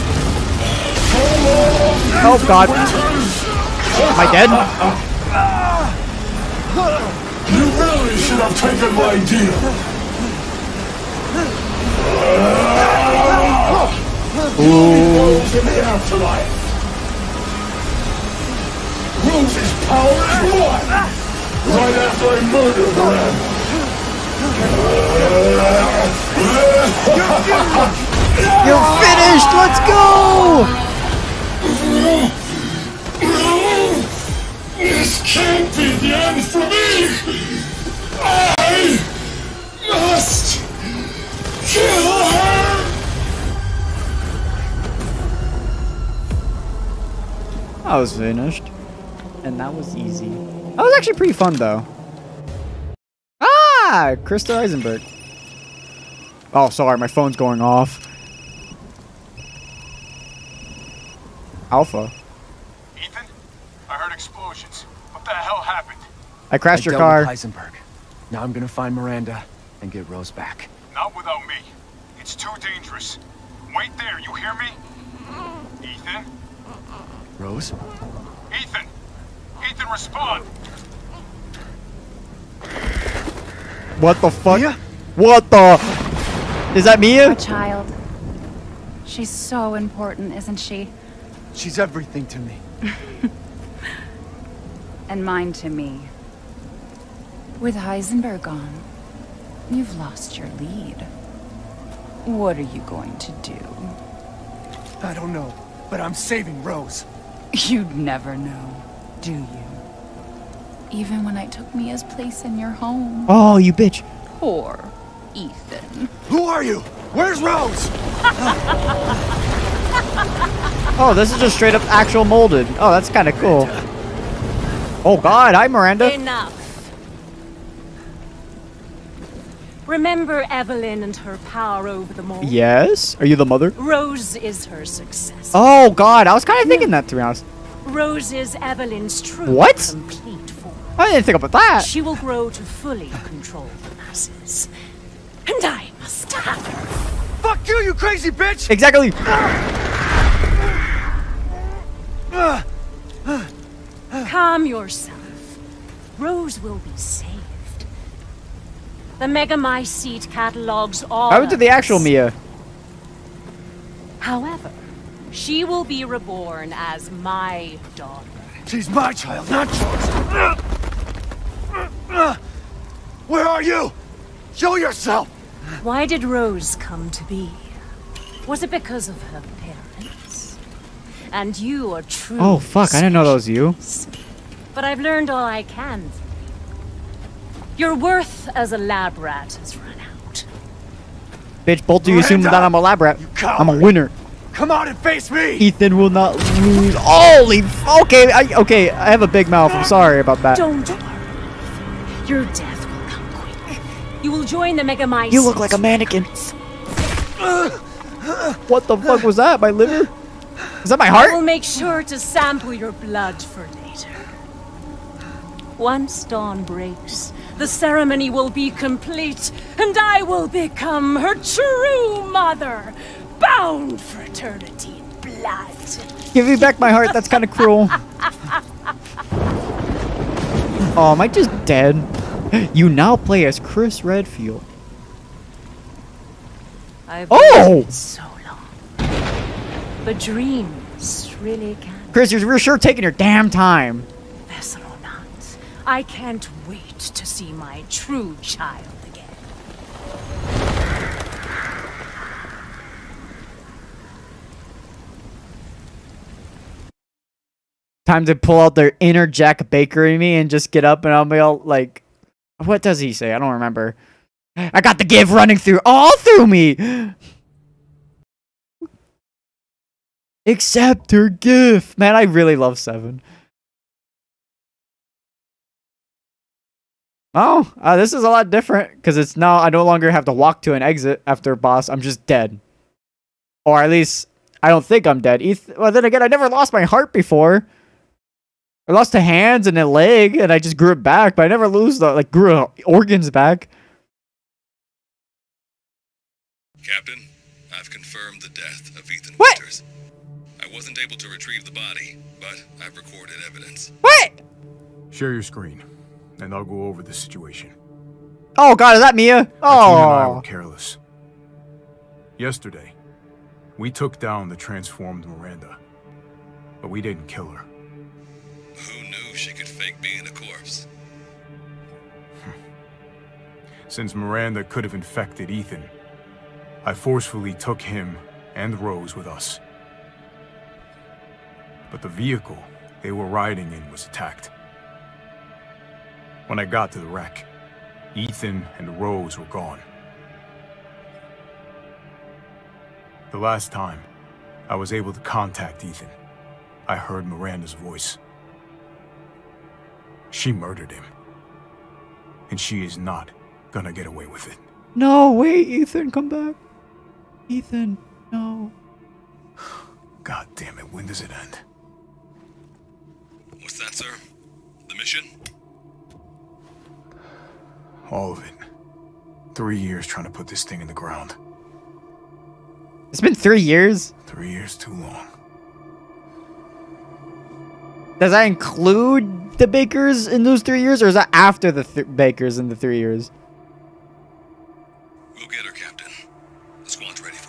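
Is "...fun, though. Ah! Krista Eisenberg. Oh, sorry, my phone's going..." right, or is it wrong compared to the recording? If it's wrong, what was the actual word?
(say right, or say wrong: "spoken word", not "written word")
right.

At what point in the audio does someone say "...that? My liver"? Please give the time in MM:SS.
03:29.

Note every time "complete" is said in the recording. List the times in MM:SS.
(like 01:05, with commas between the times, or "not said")
02:19, 03:38.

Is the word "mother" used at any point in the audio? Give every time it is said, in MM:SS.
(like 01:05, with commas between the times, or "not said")
02:13, 03:42.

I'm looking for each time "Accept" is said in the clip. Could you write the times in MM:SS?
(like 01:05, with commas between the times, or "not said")
04:30.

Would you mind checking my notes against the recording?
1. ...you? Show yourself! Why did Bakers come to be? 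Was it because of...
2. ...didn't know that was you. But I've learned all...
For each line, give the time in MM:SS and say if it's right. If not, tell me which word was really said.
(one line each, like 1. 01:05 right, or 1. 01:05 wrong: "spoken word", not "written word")
1. 02:53 wrong: "Rose", not "Bakers"
2. 03:02 right.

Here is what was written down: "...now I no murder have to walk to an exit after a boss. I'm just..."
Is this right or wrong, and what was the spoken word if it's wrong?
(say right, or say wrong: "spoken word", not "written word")
wrong: "longer", not "murder".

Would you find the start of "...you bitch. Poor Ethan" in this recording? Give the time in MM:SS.
01:53.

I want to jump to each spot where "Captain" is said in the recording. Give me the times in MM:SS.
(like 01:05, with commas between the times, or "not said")
04:56, 06:25.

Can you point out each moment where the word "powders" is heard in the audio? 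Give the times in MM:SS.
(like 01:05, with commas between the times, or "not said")
not said.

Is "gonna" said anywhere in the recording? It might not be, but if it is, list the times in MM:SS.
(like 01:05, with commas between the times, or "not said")
01:08, 05:53.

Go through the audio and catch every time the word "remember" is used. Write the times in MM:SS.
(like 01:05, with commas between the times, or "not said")
02:09, 04:23.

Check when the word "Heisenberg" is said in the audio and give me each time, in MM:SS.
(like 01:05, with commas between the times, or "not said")
01:07, 01:37.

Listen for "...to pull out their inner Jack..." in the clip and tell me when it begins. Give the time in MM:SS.
04:18.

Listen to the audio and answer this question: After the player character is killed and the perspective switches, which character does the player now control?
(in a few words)
Chris Redfield.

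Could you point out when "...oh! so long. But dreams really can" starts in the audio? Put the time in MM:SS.
03:57.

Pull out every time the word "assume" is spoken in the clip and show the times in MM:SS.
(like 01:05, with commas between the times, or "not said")
03:12.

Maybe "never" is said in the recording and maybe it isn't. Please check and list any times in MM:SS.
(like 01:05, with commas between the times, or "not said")
01:47, 04:46, 04:51.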